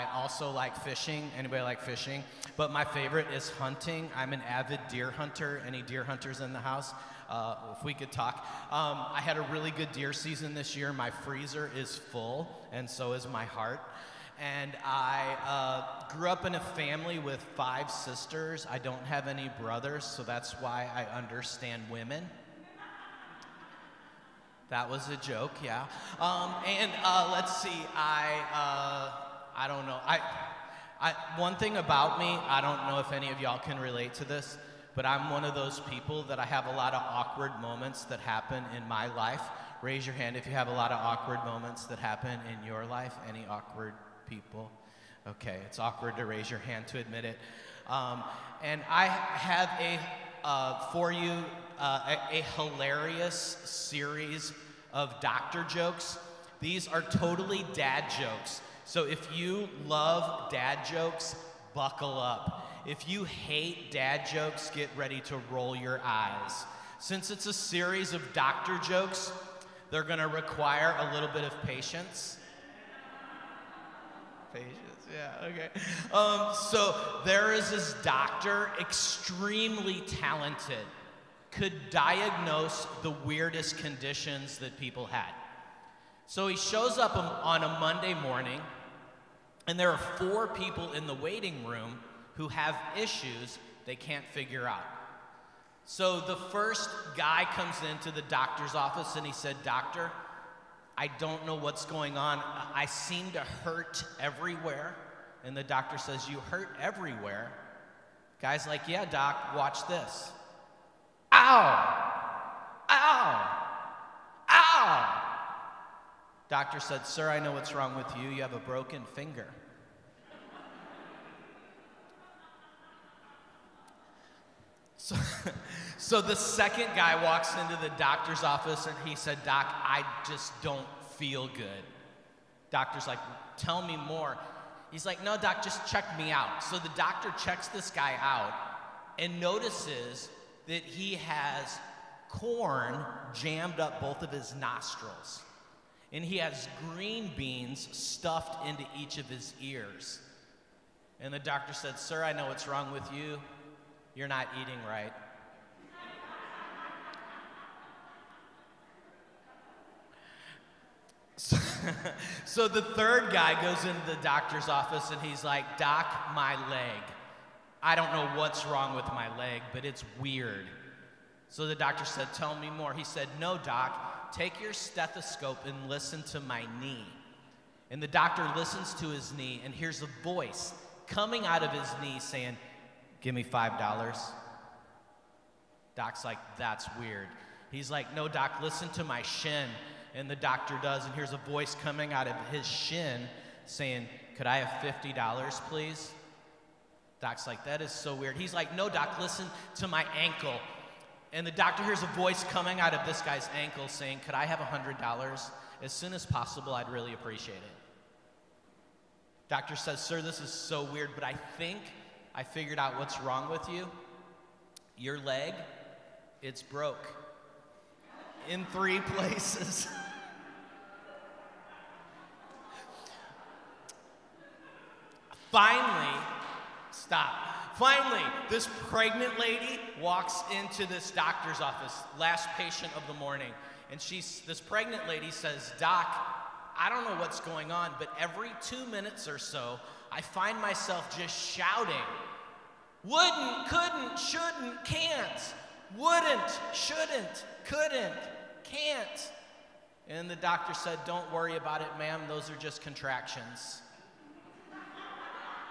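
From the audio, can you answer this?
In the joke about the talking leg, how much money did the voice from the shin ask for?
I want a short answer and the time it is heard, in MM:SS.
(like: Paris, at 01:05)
$50, at 03:14.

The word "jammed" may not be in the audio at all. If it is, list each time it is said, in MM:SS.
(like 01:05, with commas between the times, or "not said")
02:23.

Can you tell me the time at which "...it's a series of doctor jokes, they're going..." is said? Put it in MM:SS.
01:07.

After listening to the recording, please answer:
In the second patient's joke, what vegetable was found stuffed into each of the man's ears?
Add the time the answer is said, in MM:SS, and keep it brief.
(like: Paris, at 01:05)
green beans, at 02:26.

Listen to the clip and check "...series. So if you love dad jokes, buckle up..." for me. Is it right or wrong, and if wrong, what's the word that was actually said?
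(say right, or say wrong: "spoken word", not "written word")
wrong: "jokes", not "series".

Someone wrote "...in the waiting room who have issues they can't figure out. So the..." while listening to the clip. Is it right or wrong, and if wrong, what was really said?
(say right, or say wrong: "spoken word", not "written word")
right.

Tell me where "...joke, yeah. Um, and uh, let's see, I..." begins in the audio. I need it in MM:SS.
00:25.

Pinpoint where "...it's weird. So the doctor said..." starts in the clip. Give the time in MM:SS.
02:49.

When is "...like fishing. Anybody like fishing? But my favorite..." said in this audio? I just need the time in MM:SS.
00:00.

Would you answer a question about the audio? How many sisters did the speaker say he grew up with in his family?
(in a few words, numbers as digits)
5.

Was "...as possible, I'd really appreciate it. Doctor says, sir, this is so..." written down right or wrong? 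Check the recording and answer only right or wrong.
right.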